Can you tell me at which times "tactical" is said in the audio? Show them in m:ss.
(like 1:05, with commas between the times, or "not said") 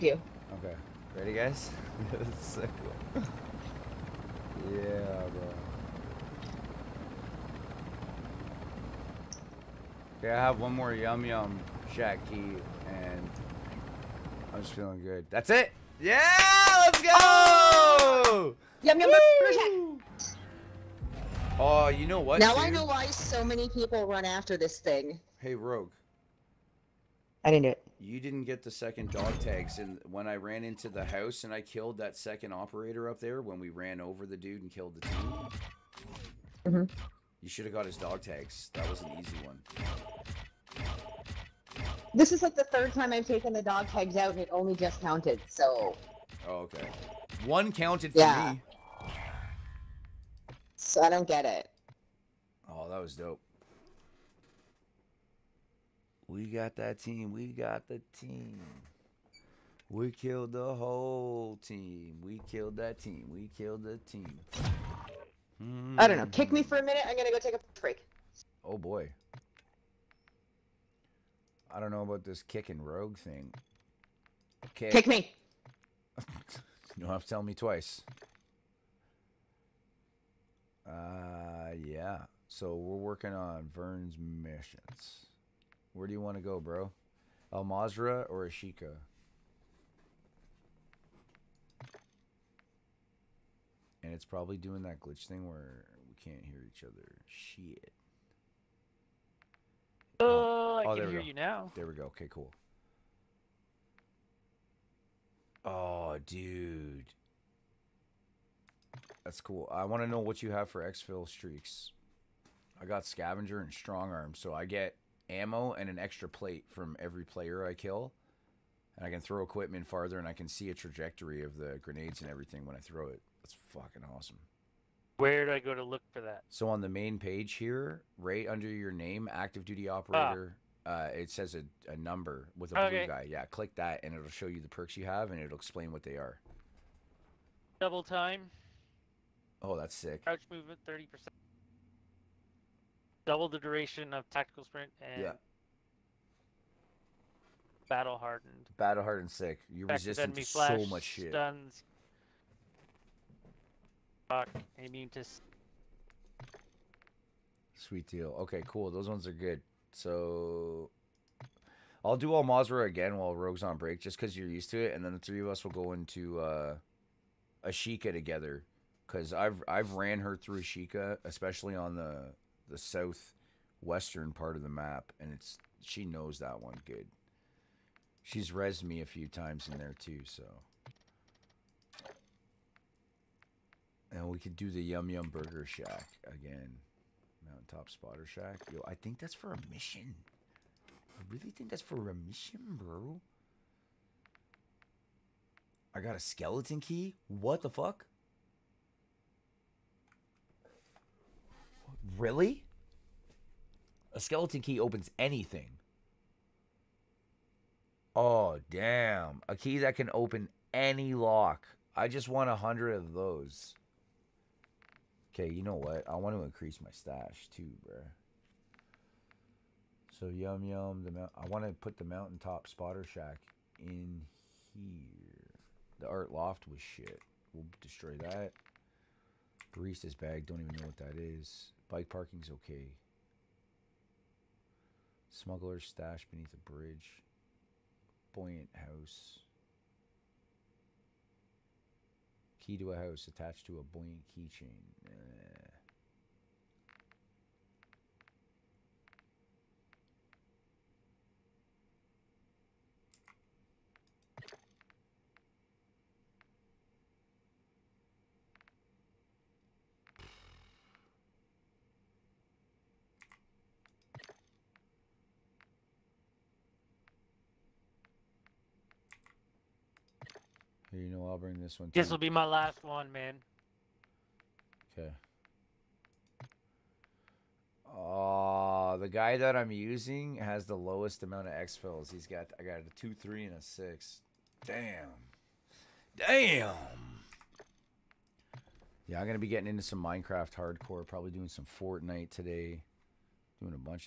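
2:24.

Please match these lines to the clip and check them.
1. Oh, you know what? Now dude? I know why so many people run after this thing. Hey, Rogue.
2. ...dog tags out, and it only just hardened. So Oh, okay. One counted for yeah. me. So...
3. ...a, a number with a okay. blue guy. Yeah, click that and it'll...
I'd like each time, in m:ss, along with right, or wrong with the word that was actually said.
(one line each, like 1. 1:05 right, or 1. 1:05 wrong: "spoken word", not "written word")
1. 0:21 right
2. 0:43 wrong: "counted", not "hardened"
3. 2:11 right.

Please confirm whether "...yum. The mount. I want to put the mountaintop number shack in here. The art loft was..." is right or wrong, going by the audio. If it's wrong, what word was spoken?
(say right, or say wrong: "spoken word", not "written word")
wrong: "spotter", not "number".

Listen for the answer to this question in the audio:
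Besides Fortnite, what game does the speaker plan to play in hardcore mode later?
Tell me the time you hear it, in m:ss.
4:50.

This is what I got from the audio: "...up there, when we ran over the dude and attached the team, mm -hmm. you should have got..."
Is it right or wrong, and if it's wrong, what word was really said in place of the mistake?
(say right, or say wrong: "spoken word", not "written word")
wrong: "killed", not "attached".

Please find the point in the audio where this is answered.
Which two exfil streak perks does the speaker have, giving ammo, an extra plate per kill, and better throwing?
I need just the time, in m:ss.
1:53.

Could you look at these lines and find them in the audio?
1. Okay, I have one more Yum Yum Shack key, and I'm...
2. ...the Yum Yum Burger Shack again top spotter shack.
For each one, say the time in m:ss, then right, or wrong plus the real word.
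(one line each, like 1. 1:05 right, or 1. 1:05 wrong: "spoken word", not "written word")
1. 0:10 right
2. 3:04 right.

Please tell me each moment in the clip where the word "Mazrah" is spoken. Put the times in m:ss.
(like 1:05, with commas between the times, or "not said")
1:27, 2:42.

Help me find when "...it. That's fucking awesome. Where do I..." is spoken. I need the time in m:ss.
2:03.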